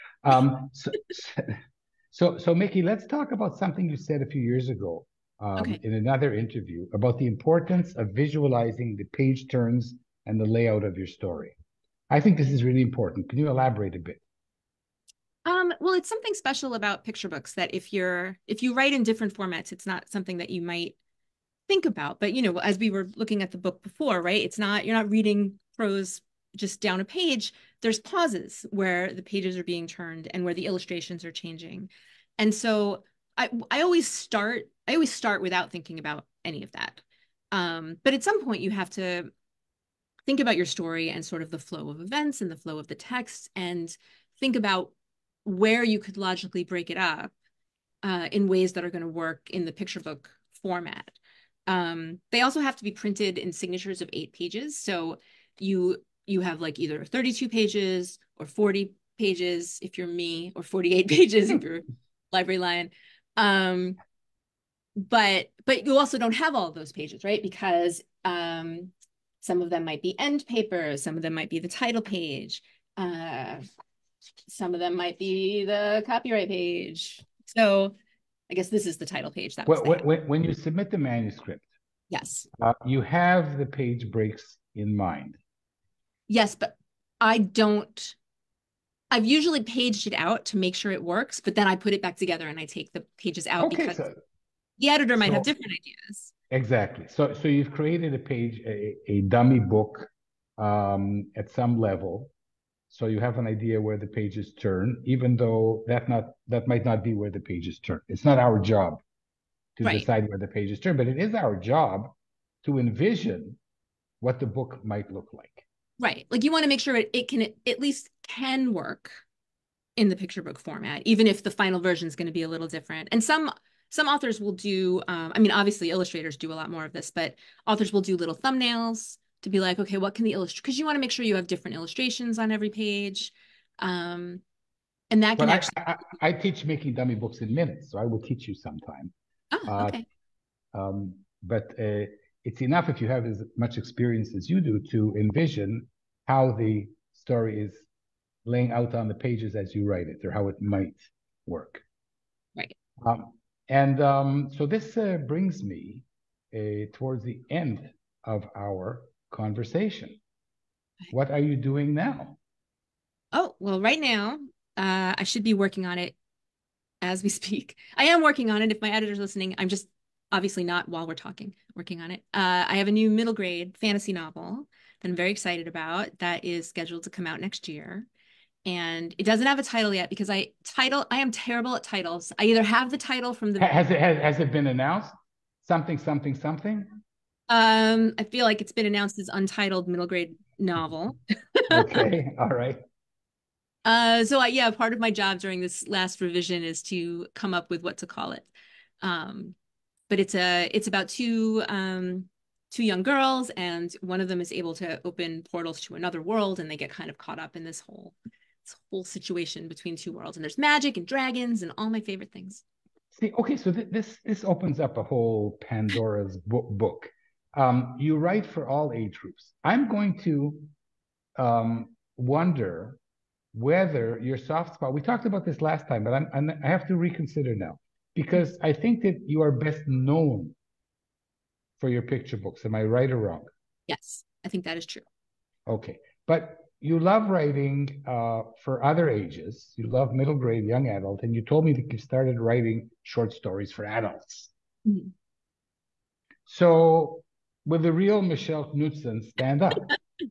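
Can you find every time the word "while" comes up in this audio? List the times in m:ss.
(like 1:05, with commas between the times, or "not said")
2:50.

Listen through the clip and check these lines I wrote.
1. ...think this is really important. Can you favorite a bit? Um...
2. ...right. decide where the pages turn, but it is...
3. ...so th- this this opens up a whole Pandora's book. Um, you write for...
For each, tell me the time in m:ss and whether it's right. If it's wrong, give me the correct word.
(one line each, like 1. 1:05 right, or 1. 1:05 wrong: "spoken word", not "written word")
1. 0:12 wrong: "elaborate", not "favorite"
2. 1:49 right
3. 3:33 right.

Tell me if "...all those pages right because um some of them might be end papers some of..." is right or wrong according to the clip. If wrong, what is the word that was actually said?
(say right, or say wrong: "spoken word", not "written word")
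right.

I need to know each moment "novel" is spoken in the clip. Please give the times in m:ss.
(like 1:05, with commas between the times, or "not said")
2:54, 3:10.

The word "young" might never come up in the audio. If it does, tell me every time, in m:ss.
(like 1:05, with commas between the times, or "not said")
3:22, 4:00.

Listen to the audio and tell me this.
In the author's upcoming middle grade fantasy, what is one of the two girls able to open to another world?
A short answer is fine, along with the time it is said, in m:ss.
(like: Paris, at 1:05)
Portals, at 3:25.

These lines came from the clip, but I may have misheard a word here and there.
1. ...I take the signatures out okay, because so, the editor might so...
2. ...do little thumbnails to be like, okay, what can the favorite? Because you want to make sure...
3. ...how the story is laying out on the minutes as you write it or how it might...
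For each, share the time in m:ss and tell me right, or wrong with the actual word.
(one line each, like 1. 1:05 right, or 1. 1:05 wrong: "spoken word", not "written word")
1. 1:32 wrong: "pages", not "signatures"
2. 2:08 wrong: "illustrate", not "favorite"
3. 2:26 wrong: "pages", not "minutes".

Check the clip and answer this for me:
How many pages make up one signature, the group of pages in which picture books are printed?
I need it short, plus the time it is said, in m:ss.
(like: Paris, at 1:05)
8, at 0:54.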